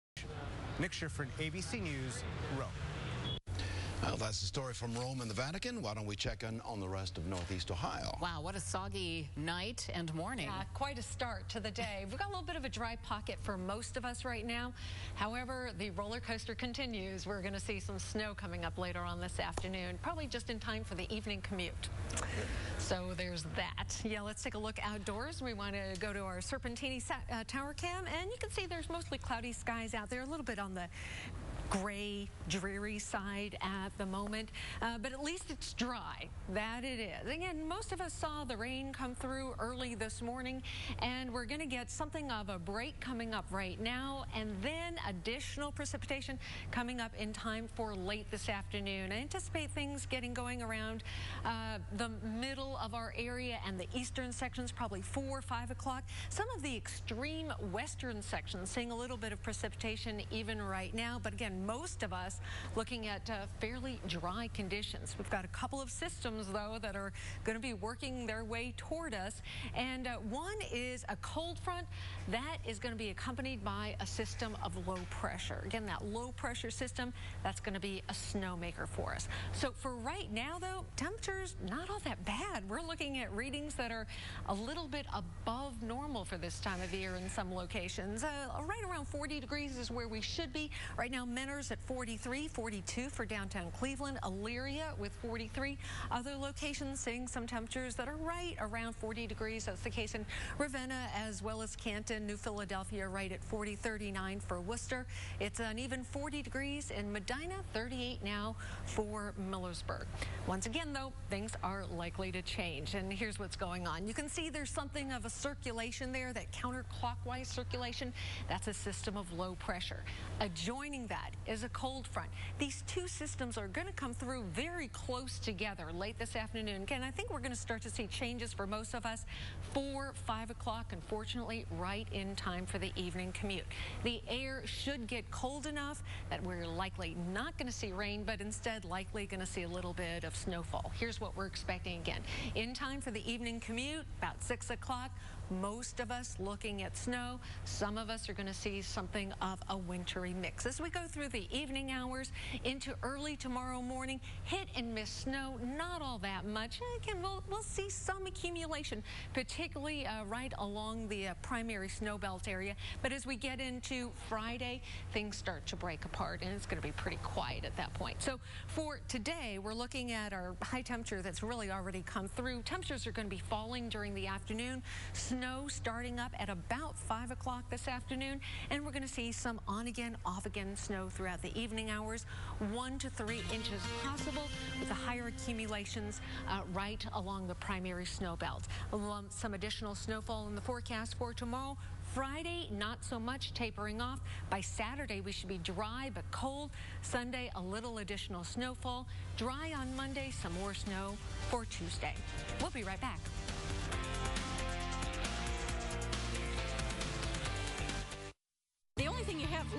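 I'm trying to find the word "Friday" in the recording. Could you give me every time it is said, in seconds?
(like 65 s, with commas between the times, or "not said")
164 s, 192 s.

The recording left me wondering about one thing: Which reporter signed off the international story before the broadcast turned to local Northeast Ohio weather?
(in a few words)
Nick Schifrin.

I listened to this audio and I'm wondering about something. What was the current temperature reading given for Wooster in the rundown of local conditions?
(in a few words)
39.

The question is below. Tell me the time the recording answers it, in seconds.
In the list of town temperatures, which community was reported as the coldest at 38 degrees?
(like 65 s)
107 s.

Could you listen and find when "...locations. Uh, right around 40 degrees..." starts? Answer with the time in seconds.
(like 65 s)
87 s.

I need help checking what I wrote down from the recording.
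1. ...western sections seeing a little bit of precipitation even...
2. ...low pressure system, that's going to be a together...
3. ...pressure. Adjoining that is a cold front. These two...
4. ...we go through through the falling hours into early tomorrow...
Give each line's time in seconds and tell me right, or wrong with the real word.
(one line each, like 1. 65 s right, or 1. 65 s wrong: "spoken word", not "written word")
1. 57 s right
2. 76 s wrong: "snowmaker", not "together"
3. 119 s right
4. 150 s wrong: "evening", not "falling".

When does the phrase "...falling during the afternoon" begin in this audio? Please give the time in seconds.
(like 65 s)
173 s.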